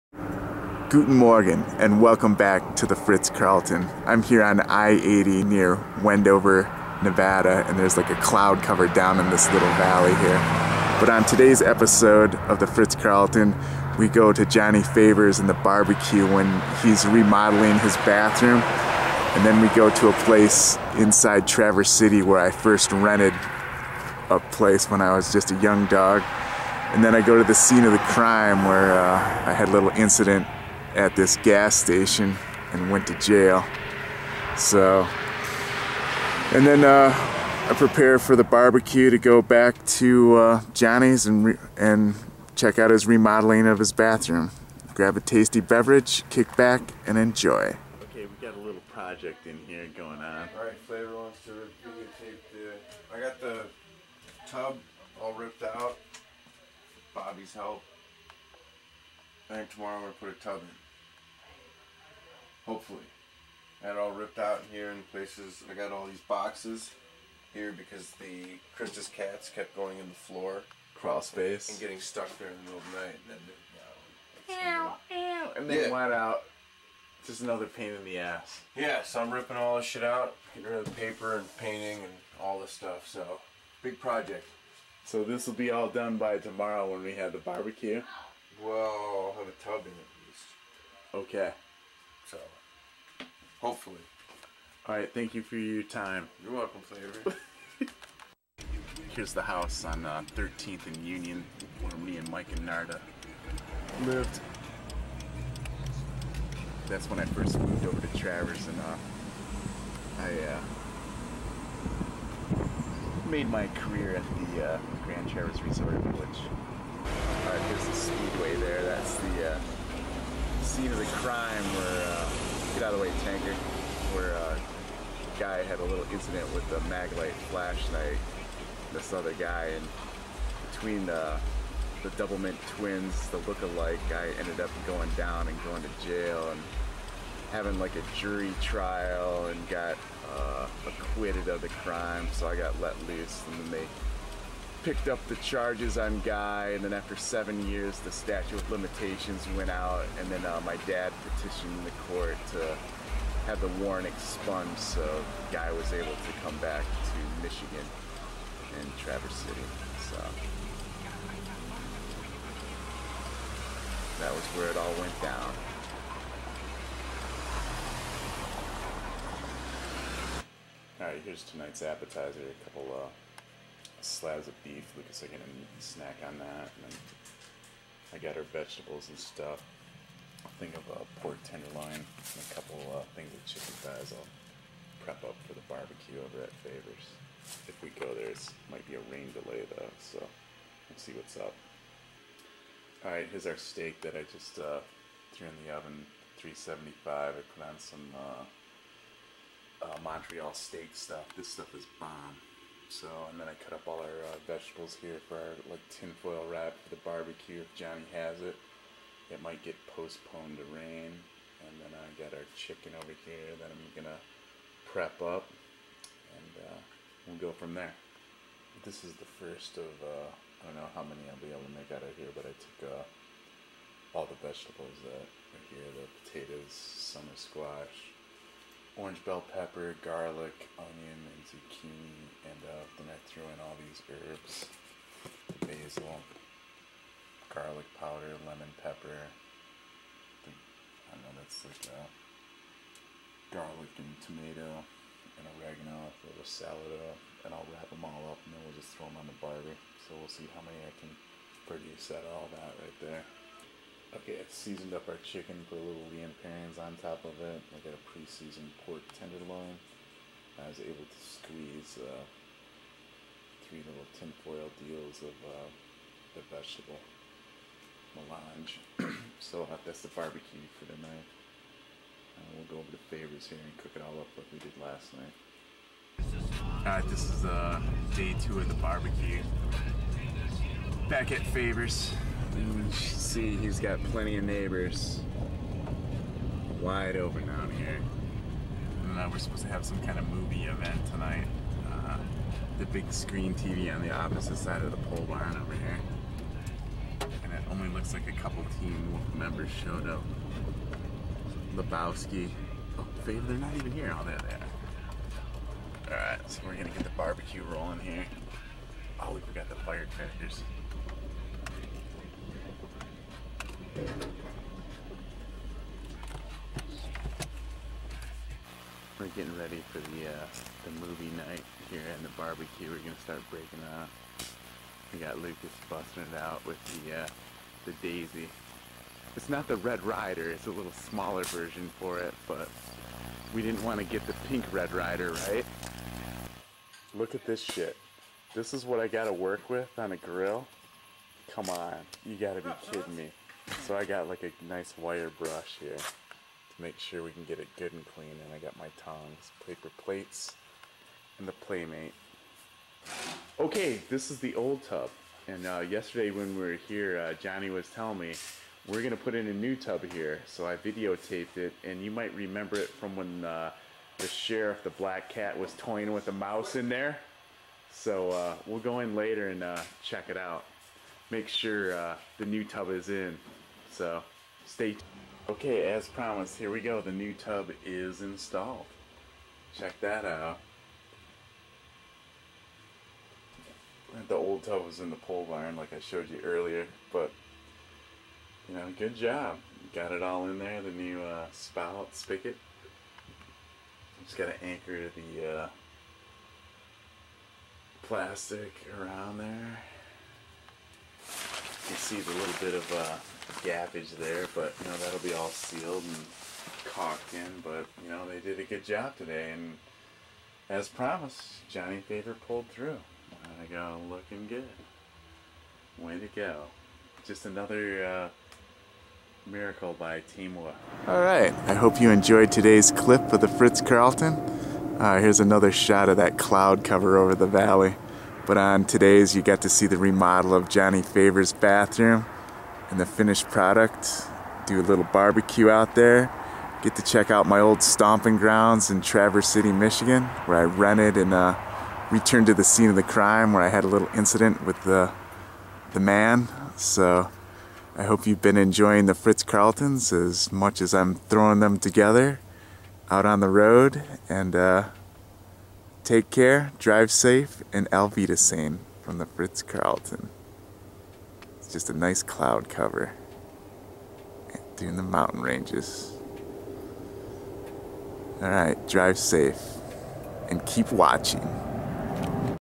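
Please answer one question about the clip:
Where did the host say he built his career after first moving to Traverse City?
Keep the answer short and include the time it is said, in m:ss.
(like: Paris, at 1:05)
Grand Traverse Resort Village, at 1:55.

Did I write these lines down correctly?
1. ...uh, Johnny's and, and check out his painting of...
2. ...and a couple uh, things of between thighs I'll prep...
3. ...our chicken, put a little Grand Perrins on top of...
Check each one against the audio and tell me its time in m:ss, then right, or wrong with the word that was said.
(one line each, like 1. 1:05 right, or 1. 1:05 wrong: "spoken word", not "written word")
1. 0:40 wrong: "remodeling", not "painting"
2. 3:02 wrong: "chicken", not "between"
3. 4:15 wrong: "Liam", not "Grand".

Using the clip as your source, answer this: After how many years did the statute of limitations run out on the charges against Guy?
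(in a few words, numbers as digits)
7.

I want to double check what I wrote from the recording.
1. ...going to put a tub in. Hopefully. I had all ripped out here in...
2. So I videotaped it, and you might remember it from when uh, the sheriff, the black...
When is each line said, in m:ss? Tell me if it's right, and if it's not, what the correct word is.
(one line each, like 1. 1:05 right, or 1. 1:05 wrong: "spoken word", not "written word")
1. 1:00 right
2. 6:00 right.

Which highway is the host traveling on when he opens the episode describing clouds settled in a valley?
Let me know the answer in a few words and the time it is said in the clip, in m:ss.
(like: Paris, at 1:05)
I-80, at 0:04.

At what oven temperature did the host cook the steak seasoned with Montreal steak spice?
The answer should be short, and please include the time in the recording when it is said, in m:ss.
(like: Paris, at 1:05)
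375, at 3:16.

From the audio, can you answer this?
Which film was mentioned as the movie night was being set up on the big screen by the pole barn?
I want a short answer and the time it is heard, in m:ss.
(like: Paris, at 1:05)
Lebowski, at 5:01.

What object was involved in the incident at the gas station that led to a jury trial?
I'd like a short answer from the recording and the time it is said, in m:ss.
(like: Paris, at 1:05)
Maglite flashlight, at 2:06.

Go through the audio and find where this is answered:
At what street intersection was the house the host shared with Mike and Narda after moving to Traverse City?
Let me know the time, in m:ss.
1:40.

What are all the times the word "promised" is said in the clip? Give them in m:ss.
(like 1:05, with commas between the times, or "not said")
6:16, 6:50.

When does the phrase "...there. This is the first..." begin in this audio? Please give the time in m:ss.
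3:37.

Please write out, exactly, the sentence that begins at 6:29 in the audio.
Got it all in there, the new uh, spout, spigot.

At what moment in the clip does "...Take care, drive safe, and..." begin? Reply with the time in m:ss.
7:36.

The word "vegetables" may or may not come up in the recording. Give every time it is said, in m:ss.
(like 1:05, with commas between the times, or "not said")
2:58, 3:24, 3:44, 4:26.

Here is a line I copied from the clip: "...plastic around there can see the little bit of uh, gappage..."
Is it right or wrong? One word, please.
right.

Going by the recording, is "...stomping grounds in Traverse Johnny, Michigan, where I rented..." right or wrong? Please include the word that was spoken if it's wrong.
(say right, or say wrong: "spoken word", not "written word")
wrong: "City", not "Johnny".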